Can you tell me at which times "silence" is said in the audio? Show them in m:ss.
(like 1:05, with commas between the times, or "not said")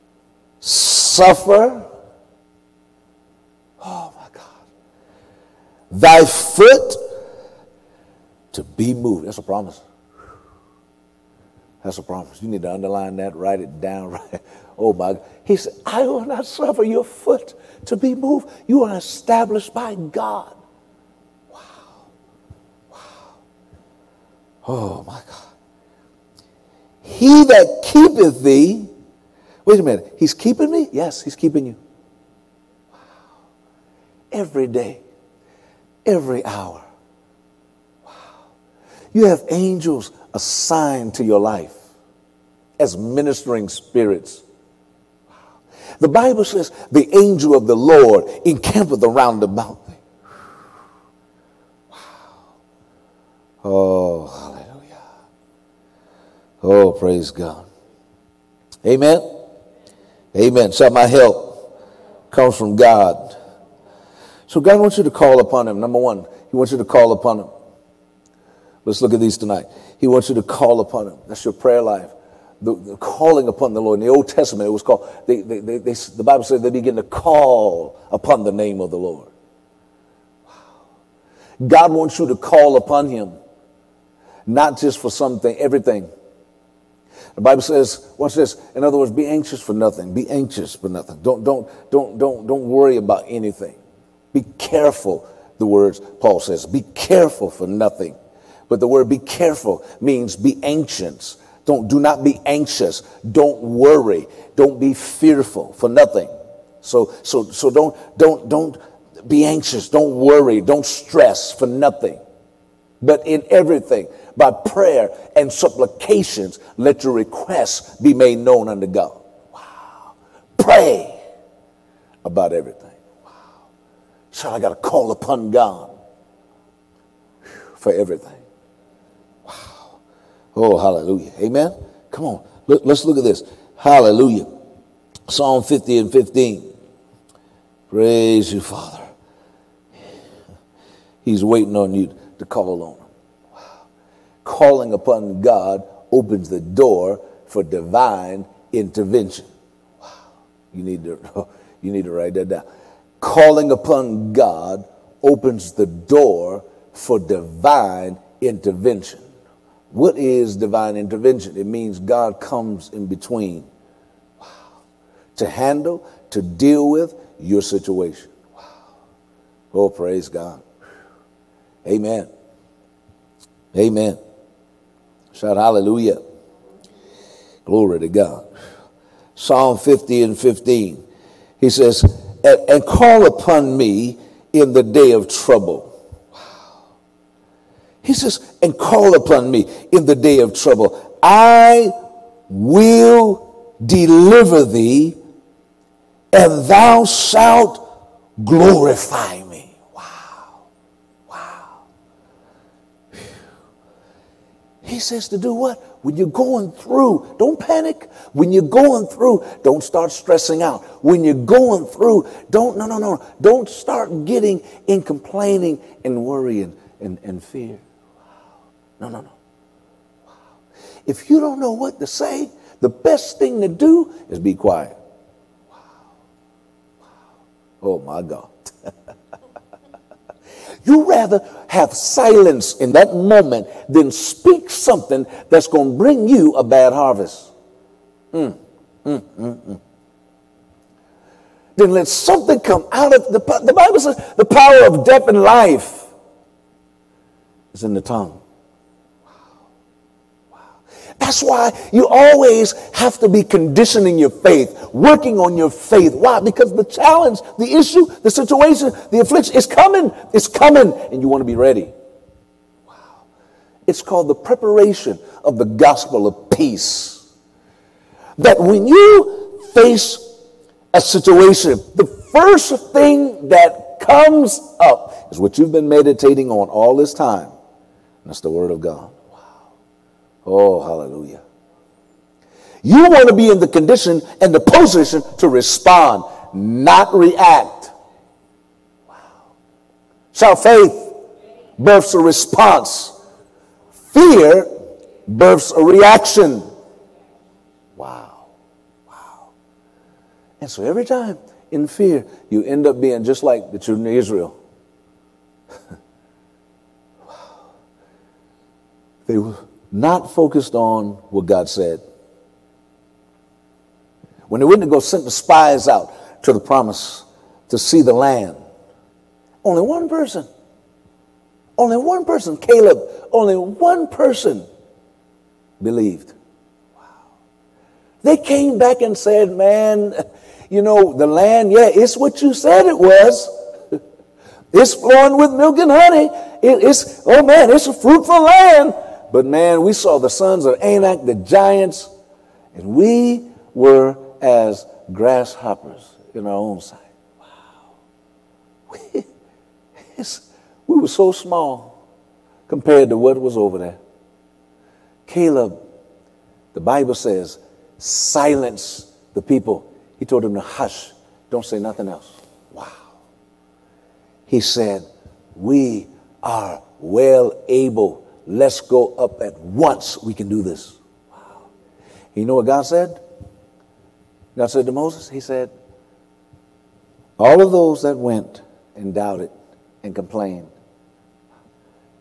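3:51, 5:57.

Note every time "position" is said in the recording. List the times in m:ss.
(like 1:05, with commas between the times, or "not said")
4:44.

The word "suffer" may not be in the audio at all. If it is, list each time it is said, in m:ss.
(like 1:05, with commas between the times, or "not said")
0:00, 0:16.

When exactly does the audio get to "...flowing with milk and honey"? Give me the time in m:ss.
5:34.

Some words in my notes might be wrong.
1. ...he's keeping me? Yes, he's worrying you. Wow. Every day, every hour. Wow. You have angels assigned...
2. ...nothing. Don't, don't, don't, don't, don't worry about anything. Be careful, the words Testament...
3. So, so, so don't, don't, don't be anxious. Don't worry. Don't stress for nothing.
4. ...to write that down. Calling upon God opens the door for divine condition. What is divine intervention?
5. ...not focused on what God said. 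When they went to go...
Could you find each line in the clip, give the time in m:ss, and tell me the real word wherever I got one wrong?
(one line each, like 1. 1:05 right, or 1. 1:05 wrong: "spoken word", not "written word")
1. 0:30 wrong: "keeping", not "worrying"
2. 1:30 wrong: "Paul", not "Testament"
3. 1:46 right
4. 2:32 wrong: "intervention", not "condition"
5. 5:09 right.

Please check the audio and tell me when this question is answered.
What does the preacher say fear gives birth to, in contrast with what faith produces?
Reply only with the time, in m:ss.
4:54.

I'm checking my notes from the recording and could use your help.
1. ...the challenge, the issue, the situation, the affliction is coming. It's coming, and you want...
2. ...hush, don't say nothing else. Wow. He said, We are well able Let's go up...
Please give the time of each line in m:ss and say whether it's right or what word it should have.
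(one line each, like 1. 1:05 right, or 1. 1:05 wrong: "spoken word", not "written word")
1. 4:16 right
2. 6:00 right.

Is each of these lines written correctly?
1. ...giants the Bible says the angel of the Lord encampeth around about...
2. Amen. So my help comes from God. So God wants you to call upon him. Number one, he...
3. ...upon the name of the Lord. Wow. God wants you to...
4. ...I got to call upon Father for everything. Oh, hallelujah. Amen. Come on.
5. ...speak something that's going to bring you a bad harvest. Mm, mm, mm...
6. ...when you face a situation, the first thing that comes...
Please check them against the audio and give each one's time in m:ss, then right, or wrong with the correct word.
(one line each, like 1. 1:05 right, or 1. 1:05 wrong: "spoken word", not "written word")
1. 0:43 wrong: "spirits", not "giants"
2. 1:00 right
3. 1:18 right
4. 2:04 wrong: "God", not "Father"
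5. 3:54 right
6. 4:28 right.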